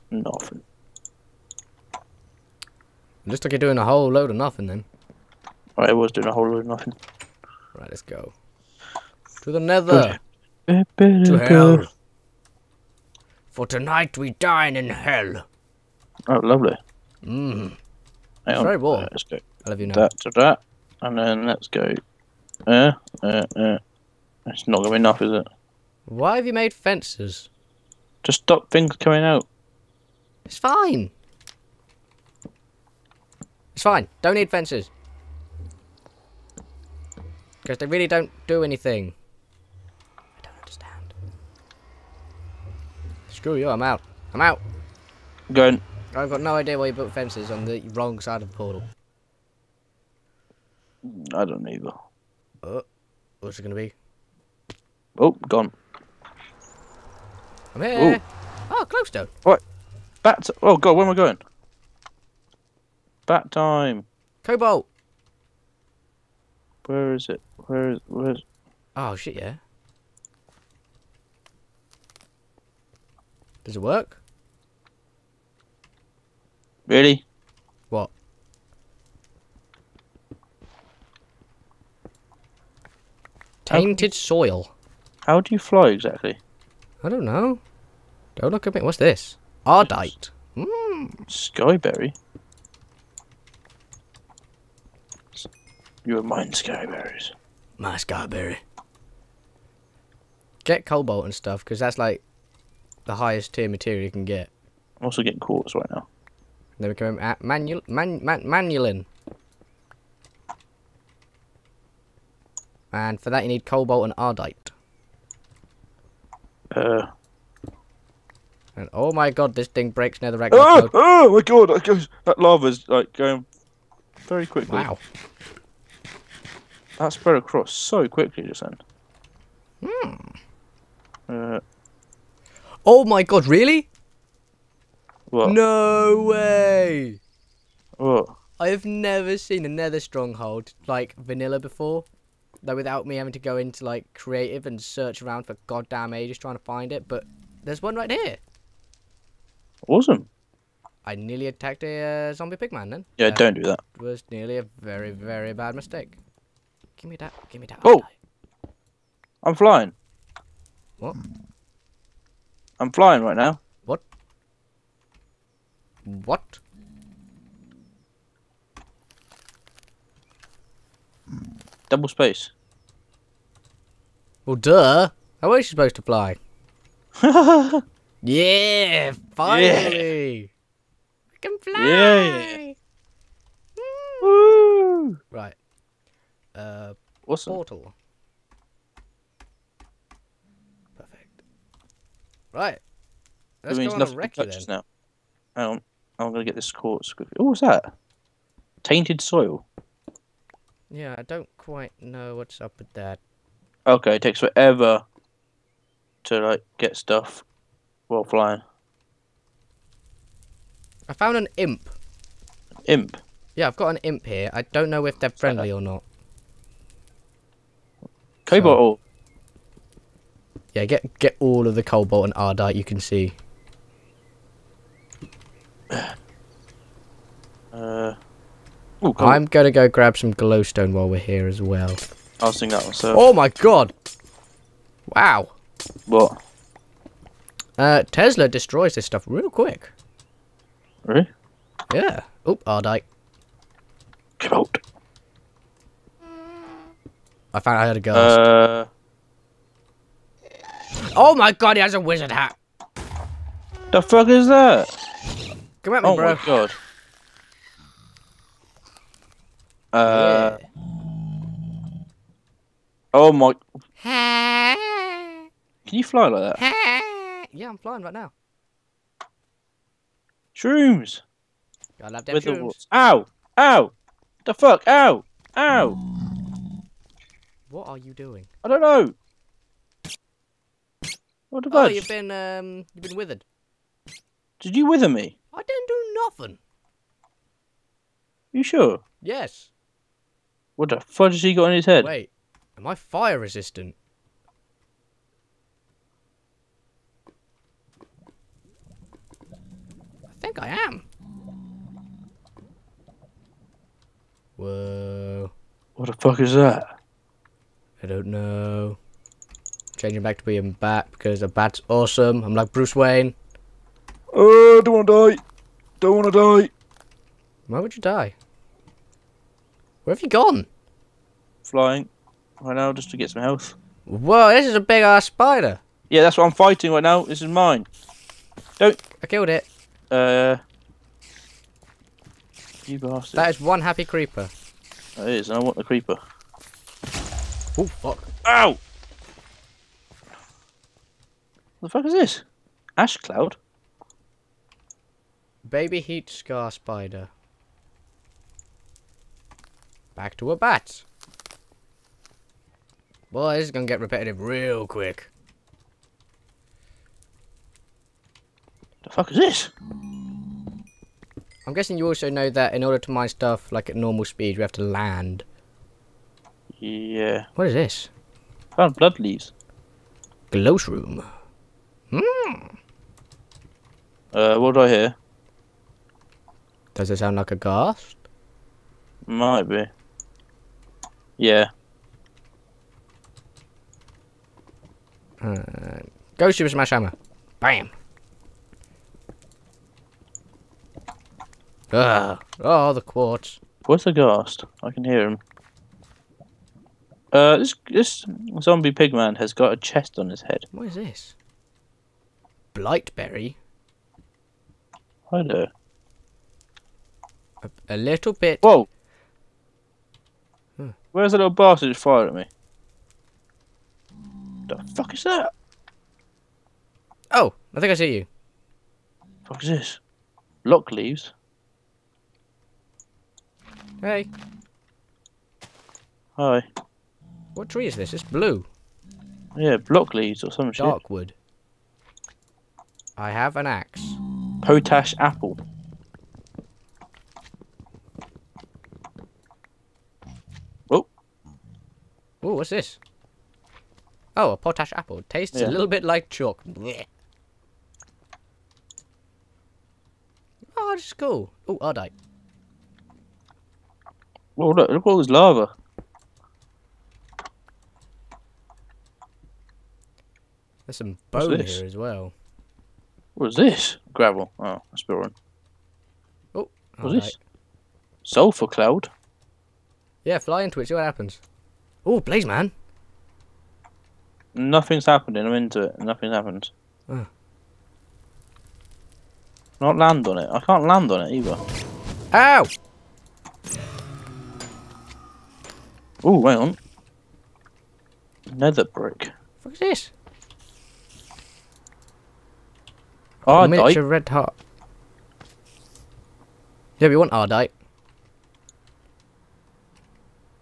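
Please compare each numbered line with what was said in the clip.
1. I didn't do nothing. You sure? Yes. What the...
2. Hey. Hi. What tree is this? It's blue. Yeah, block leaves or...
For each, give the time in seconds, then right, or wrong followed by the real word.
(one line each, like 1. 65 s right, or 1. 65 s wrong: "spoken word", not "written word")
1. 285 s right
2. 424 s right.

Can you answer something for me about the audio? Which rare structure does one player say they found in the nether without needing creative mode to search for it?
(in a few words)
Nether stronghold.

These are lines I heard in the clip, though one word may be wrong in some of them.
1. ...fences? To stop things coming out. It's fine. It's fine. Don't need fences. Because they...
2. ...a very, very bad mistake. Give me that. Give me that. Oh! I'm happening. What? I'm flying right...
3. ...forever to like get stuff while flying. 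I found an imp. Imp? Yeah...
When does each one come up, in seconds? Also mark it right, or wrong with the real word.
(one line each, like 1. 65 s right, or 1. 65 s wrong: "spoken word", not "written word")
1. 26 s right
2. 154 s wrong: "flying", not "happening"
3. 204 s right.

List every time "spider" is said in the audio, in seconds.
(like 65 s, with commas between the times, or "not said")
325 s, 346 s.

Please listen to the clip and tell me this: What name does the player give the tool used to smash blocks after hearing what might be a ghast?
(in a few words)
Super Smash Hammer.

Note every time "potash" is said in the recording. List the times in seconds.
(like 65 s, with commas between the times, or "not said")
434 s, 444 s.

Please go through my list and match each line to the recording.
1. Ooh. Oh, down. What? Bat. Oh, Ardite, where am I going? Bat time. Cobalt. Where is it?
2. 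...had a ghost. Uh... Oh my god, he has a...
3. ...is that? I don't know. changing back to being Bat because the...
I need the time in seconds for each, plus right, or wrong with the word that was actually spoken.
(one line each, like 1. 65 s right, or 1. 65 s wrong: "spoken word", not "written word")
1. 58 s wrong: "God", not "Ardite"
2. 247 s right
3. 306 s right.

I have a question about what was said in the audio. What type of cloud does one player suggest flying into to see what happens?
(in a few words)
Sulfur cloud.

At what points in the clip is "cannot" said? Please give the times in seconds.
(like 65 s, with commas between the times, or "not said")
not said.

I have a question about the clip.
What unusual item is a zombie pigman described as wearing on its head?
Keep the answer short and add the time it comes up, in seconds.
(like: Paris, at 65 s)
A chest, at 399 s.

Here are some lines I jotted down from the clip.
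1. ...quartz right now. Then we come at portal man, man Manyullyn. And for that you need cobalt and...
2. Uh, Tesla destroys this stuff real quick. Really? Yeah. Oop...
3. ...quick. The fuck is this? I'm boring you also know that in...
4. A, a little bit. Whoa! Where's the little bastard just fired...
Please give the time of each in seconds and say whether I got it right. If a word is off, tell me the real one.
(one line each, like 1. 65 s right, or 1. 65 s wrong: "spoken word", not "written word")
1. 105 s wrong: "manual", not "portal"
2. 237 s right
3. 354 s wrong: "guessing", not "boring"
4. 407 s right.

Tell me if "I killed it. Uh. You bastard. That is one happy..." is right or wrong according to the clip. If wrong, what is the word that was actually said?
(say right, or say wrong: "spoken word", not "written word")
right.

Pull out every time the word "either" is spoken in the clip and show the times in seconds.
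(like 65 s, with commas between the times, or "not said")
51 s, 481 s.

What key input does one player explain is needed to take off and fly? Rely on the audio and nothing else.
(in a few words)
Double space.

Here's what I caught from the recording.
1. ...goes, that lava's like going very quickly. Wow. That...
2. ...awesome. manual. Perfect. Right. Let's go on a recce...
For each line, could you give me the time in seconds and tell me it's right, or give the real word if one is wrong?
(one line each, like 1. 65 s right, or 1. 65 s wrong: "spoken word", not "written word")
1. 121 s right
2. 187 s wrong: "portal", not "manual".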